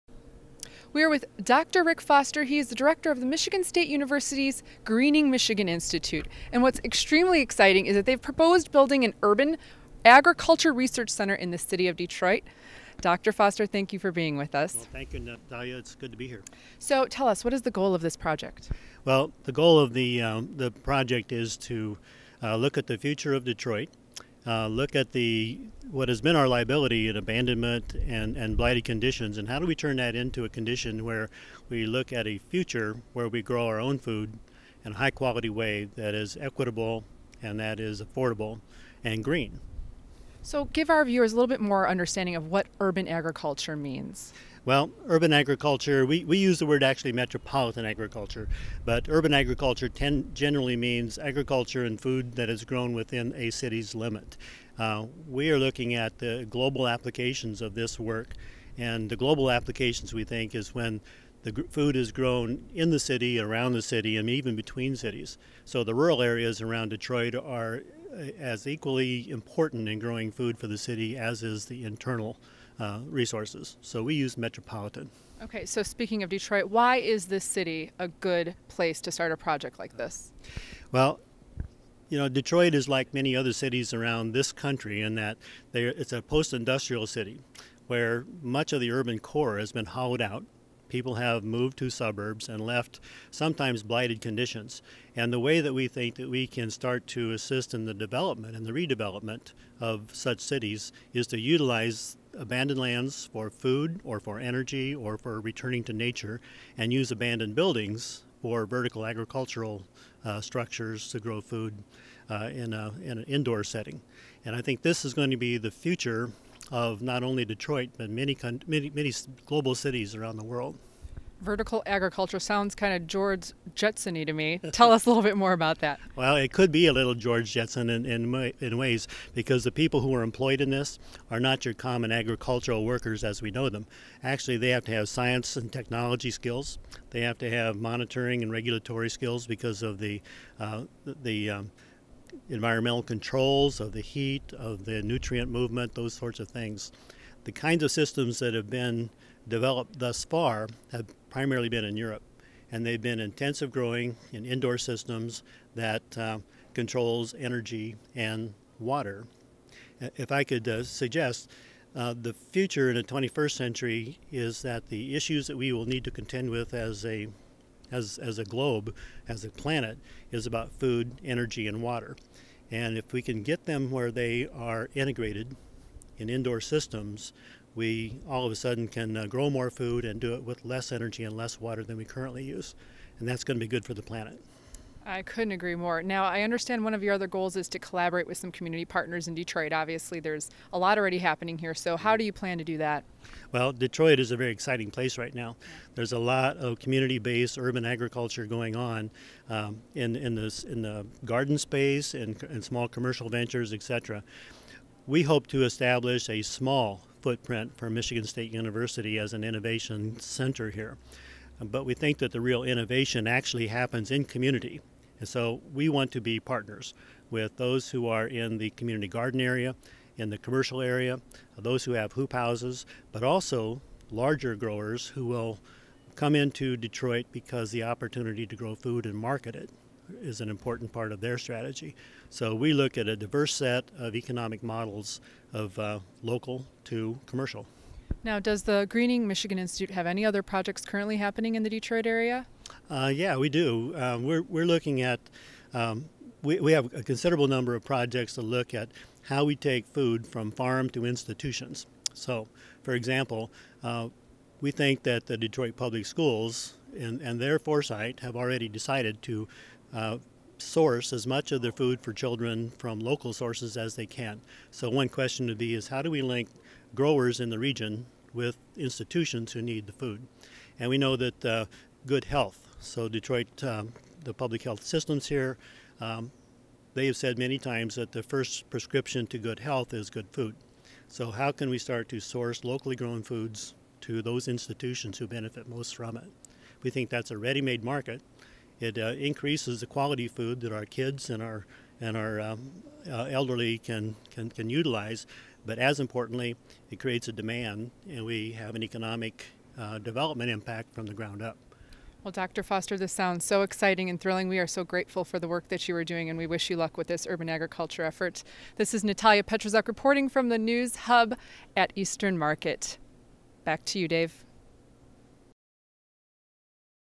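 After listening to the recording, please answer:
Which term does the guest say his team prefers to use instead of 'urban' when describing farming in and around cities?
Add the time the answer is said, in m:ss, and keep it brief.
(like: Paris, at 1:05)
metropolitan agriculture, at 0:47.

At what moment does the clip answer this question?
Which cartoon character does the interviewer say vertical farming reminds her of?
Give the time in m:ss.
2:03.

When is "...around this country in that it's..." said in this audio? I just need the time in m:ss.
1:23.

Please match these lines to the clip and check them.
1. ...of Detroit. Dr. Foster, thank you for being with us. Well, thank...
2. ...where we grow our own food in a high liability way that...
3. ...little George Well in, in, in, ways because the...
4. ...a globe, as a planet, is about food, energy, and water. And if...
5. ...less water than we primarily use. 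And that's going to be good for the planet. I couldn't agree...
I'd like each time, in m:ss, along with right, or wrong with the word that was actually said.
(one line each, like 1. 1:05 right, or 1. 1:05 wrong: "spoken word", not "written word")
1. 0:11 right
2. 0:33 wrong: "quality", not "liability"
3. 2:06 wrong: "Jetson", not "Well"
4. 2:48 right
5. 3:01 wrong: "currently", not "primarily".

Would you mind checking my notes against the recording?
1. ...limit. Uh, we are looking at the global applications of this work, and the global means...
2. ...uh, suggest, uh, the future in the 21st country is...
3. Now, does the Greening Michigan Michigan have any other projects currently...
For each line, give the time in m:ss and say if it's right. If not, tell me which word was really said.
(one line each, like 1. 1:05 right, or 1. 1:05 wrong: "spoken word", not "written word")
1. 0:53 wrong: "applications", not "means"
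2. 2:40 wrong: "century", not "country"
3. 3:58 wrong: "Institute", not "Michigan".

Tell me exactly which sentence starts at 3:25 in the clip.
We hope to establish a small footprint for Michigan State University as an innovation center here.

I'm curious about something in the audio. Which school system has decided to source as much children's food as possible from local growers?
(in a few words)
Detroit Public Schools.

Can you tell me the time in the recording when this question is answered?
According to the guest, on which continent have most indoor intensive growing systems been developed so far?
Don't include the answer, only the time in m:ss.
2:31.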